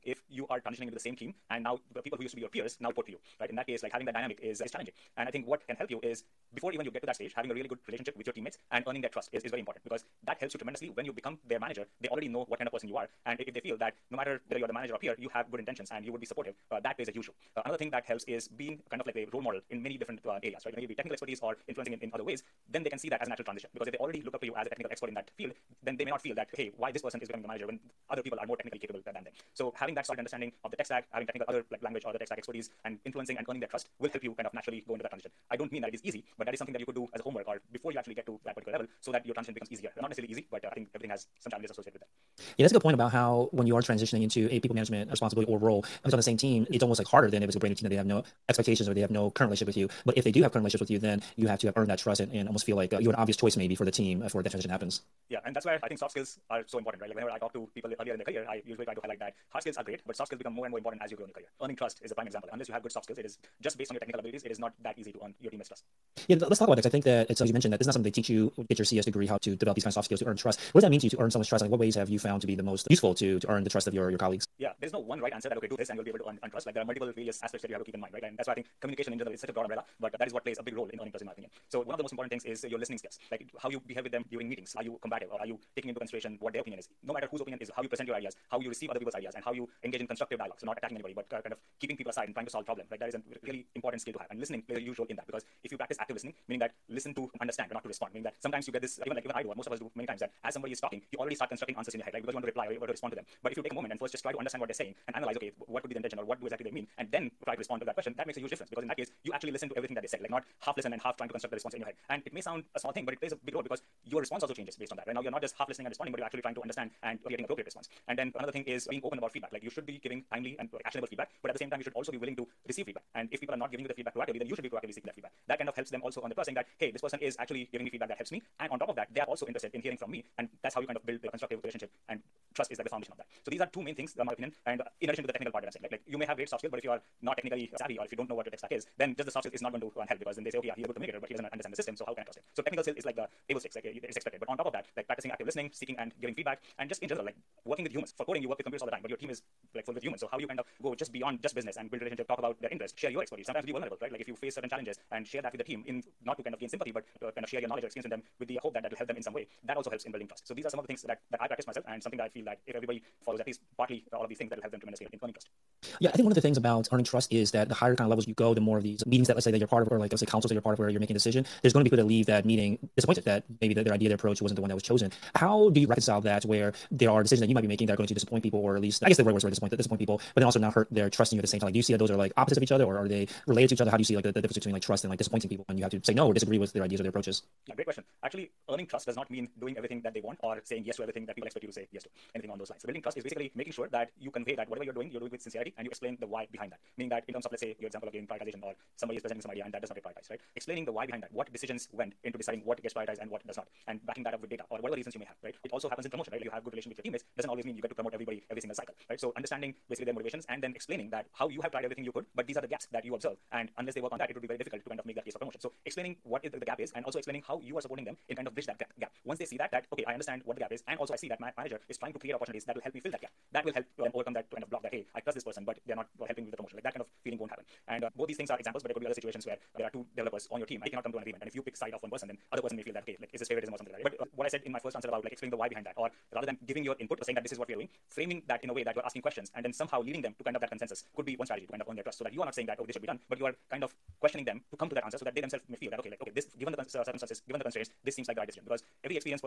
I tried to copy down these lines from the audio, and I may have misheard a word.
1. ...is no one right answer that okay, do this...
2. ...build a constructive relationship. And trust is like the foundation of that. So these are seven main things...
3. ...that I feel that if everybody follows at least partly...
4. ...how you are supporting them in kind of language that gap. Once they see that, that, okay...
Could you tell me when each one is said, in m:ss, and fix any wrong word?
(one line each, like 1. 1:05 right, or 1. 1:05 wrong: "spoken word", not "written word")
1. 1:14 right
2. 2:11 wrong: "two", not "seven"
3. 2:42 right
4. 3:37 wrong: "bridge", not "language".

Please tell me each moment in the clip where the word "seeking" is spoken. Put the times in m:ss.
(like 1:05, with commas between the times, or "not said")
2:04, 2:25.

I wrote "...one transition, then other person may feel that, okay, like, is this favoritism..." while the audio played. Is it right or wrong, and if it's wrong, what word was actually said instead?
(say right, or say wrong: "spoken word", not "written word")
wrong: "person", not "transition".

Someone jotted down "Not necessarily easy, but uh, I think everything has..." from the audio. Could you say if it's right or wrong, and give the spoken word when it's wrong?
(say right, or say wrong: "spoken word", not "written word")
right.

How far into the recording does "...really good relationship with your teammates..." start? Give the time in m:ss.
0:07.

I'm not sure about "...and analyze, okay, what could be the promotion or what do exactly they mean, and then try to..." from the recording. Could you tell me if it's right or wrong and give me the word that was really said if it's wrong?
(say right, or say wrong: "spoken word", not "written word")
wrong: "intention", not "promotion".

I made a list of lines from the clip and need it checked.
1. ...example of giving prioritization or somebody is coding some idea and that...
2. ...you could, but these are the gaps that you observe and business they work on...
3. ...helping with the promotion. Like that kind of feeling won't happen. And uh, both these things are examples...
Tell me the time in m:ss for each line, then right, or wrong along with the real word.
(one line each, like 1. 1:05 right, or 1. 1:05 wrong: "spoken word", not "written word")
1. 3:17 wrong: "presenting", not "coding"
2. 3:32 wrong: "unless", not "business"
3. 3:46 right.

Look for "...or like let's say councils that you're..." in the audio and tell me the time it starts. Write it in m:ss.
2:49.